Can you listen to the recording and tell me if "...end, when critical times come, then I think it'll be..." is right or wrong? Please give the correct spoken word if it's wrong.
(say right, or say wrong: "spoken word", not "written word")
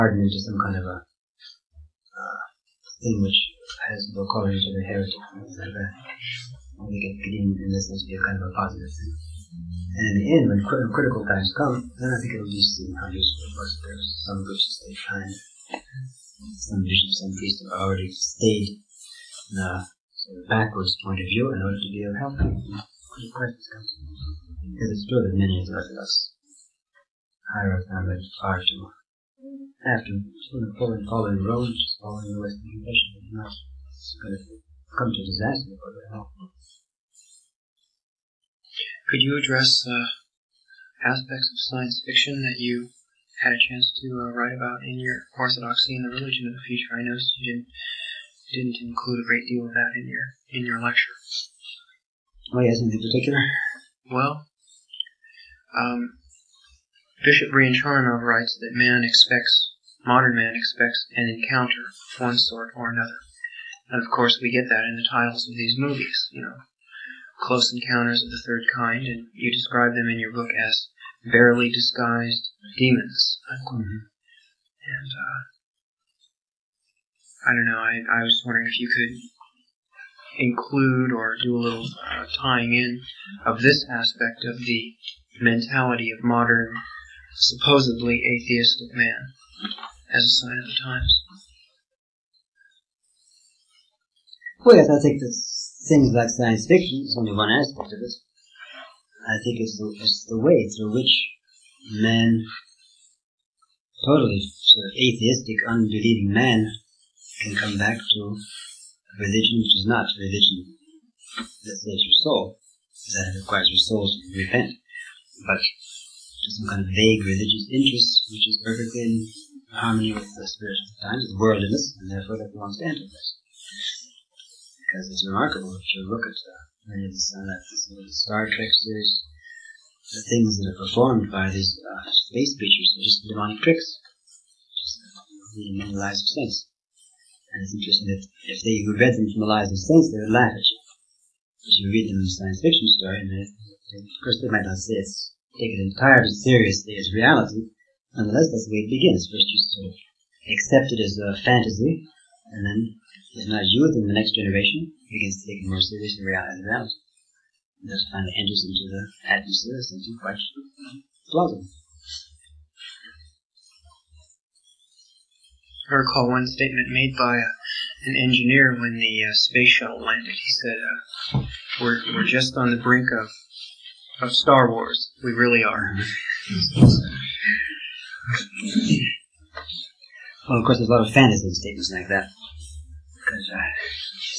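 right.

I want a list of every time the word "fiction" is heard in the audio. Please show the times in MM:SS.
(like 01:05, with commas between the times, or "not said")
00:42, 01:36, 02:22.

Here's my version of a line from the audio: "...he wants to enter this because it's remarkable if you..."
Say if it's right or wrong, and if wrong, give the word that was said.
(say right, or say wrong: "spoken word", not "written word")
right.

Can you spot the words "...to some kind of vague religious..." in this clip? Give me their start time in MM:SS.
01:55.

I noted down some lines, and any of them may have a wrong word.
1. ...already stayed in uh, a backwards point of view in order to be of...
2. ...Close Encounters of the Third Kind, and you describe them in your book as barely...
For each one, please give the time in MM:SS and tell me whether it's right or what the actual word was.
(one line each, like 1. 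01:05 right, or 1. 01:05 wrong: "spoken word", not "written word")
1. 00:17 right
2. 01:07 right.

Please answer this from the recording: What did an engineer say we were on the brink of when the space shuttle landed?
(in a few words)
Star Wars.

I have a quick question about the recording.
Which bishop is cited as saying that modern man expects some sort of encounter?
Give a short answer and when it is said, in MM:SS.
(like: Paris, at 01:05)
Bishop Charnov, at 00:57.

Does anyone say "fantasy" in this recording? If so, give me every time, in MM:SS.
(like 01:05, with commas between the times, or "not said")
02:31, 03:01.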